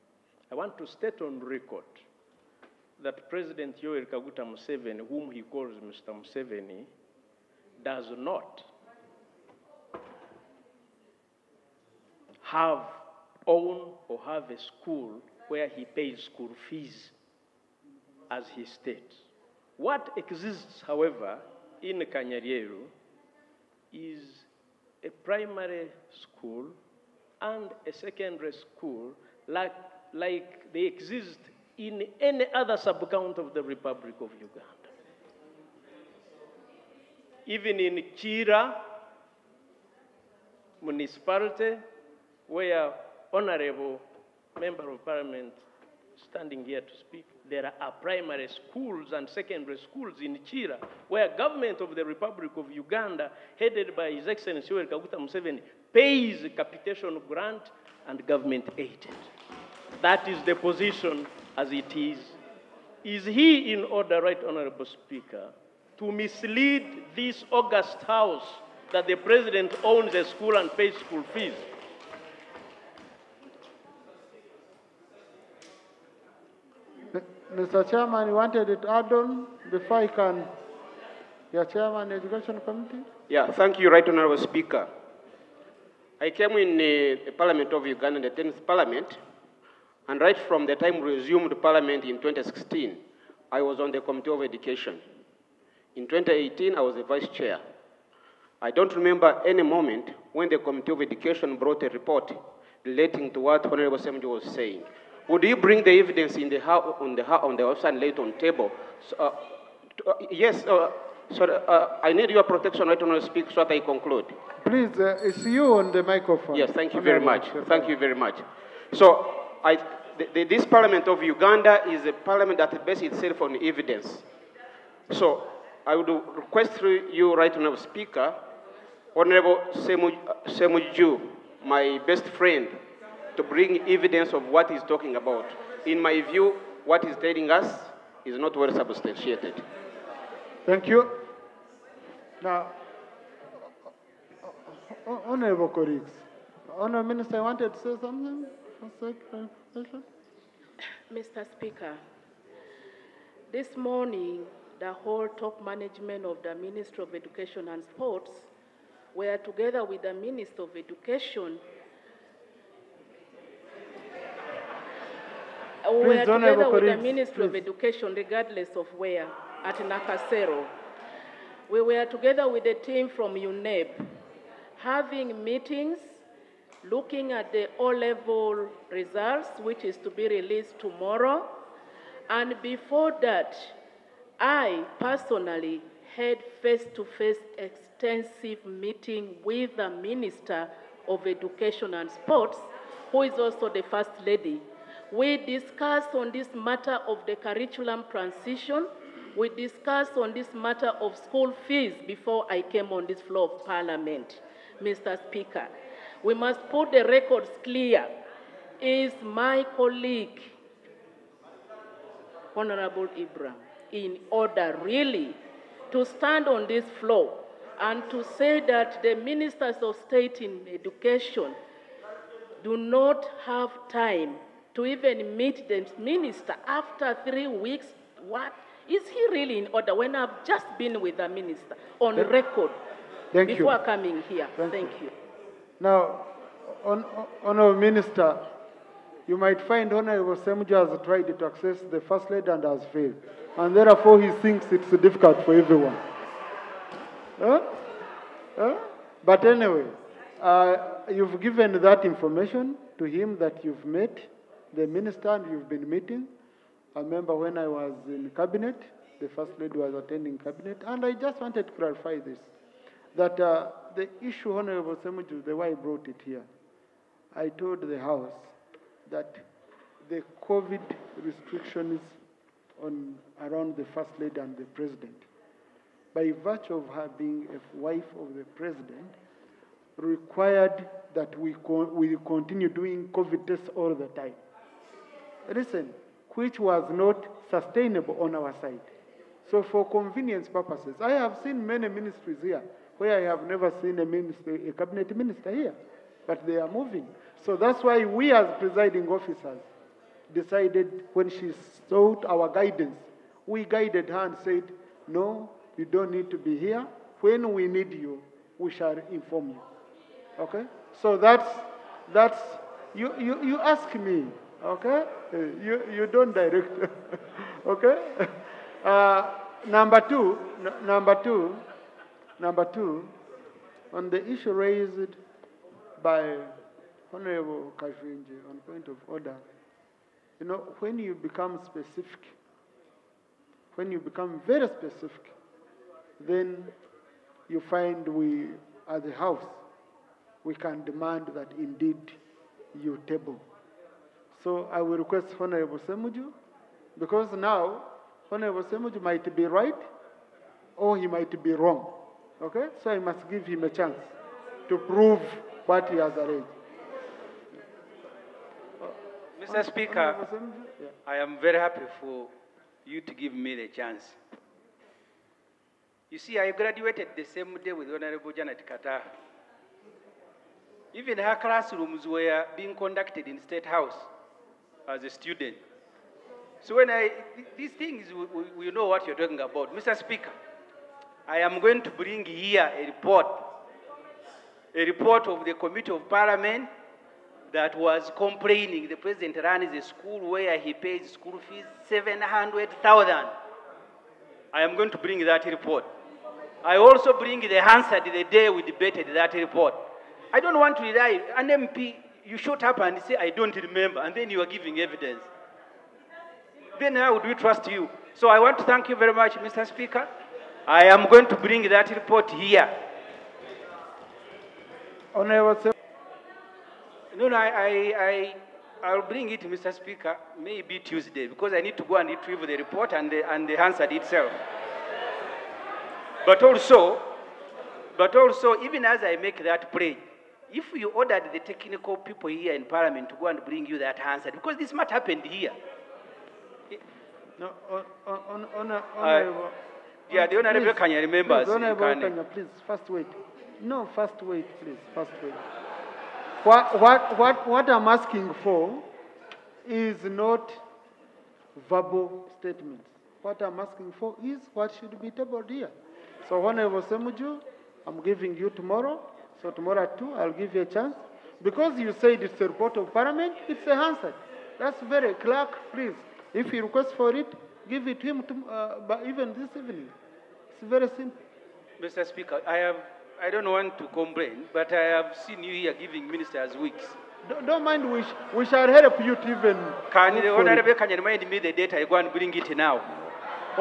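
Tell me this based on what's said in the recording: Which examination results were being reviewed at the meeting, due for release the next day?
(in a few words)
O-level.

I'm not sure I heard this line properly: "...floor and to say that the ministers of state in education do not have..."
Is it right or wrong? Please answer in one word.
right.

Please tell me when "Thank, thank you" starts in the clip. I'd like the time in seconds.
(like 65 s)
234 s.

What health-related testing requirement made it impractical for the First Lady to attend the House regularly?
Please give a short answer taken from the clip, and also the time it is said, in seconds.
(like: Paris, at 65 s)
COVID tests, at 283 s.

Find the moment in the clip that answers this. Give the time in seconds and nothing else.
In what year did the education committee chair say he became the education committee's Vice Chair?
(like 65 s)
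96 s.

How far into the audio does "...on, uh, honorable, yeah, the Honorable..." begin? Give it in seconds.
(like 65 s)
438 s.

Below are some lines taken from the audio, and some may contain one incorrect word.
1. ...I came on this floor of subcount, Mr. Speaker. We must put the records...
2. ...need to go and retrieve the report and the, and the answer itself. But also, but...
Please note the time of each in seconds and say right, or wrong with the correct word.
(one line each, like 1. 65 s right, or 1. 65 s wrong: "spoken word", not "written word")
1. 202 s wrong: "parliament", not "subcount"
2. 421 s right.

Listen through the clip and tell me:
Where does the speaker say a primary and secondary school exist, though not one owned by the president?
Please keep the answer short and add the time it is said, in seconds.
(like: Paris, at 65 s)
Kanyareru, at 22 s.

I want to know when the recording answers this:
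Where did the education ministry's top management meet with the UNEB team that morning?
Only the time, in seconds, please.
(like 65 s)
169 s.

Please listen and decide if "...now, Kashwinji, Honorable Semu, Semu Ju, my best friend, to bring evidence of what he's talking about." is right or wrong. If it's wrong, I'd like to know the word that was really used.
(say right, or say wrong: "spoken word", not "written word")
wrong: "Speaker", not "Kashwinji".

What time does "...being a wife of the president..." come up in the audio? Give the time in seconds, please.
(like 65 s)
277 s.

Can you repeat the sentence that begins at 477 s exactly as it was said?
Don't, don't mind, we, sh we shall help you to even.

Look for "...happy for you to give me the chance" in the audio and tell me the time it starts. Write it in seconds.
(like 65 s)
361 s.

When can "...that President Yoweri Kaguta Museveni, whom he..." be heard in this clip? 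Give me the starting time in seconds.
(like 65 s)
3 s.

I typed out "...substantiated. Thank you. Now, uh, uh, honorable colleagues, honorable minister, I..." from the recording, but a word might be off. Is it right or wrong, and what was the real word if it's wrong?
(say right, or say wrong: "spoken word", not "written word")
right.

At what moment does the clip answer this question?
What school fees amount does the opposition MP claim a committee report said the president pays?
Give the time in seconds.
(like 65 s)
391 s.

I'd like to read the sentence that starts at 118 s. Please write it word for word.
So I, the, the, this parliament of Uganda is a parliament that bases itself on evidence.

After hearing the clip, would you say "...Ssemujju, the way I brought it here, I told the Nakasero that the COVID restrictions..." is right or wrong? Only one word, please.
wrong.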